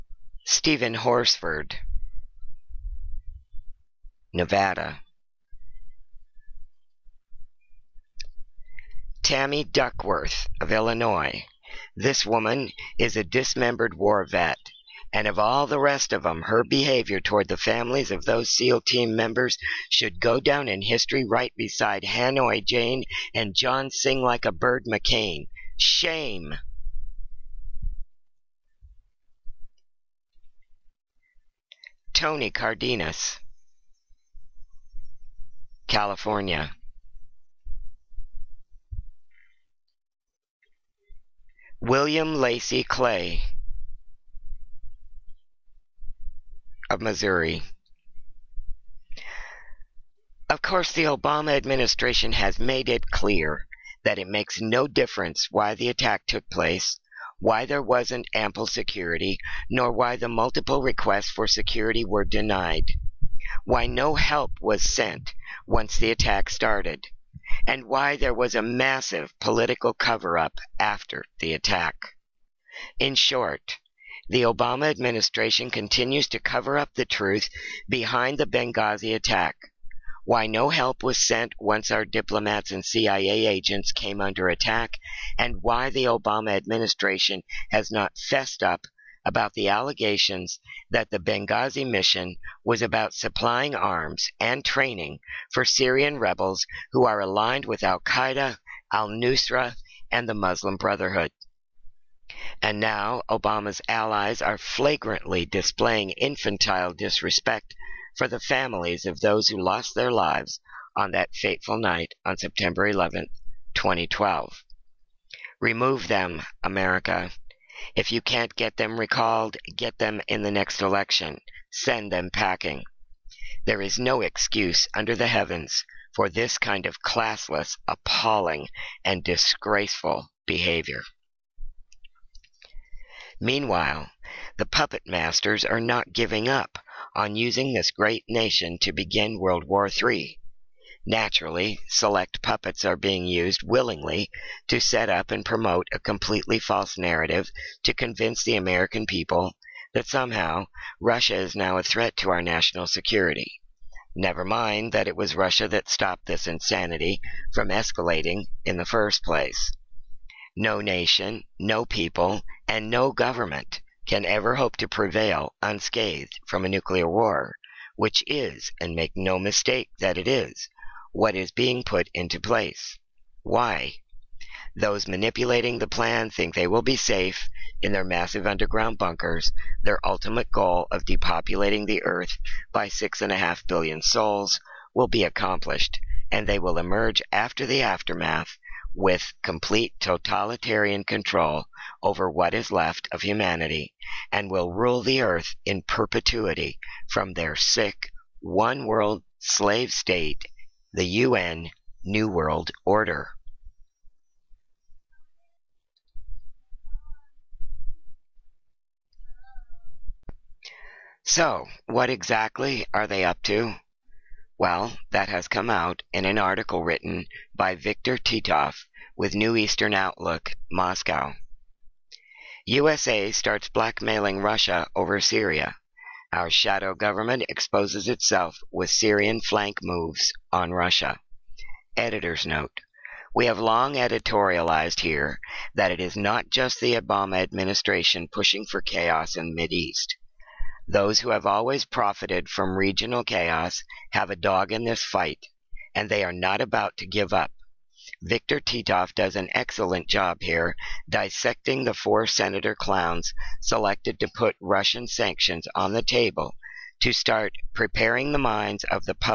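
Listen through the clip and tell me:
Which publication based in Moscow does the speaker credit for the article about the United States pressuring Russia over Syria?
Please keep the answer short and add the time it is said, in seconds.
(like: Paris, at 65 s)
New Eastern Outlook, at 219 s.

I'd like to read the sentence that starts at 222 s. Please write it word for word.
USA starts blackmailing Russia over Syria.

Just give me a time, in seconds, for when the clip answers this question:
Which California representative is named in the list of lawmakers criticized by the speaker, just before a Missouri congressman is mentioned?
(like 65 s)
32 s.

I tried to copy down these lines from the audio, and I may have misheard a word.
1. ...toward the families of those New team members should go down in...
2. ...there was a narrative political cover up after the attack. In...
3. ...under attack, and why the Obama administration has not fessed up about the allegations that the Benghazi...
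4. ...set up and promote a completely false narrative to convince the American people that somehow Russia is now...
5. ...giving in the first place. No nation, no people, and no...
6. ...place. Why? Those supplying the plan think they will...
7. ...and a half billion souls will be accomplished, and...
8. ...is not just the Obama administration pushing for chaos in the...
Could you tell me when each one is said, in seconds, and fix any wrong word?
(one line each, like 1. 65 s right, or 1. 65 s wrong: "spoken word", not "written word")
1. 17 s wrong: "SEAL", not "New"
2. 68 s wrong: "massive", not "narrative"
3. 84 s right
4. 144 s right
5. 157 s wrong: "escalating", not "giving"
6. 172 s wrong: "manipulating", not "supplying"
7. 183 s right
8. 235 s right.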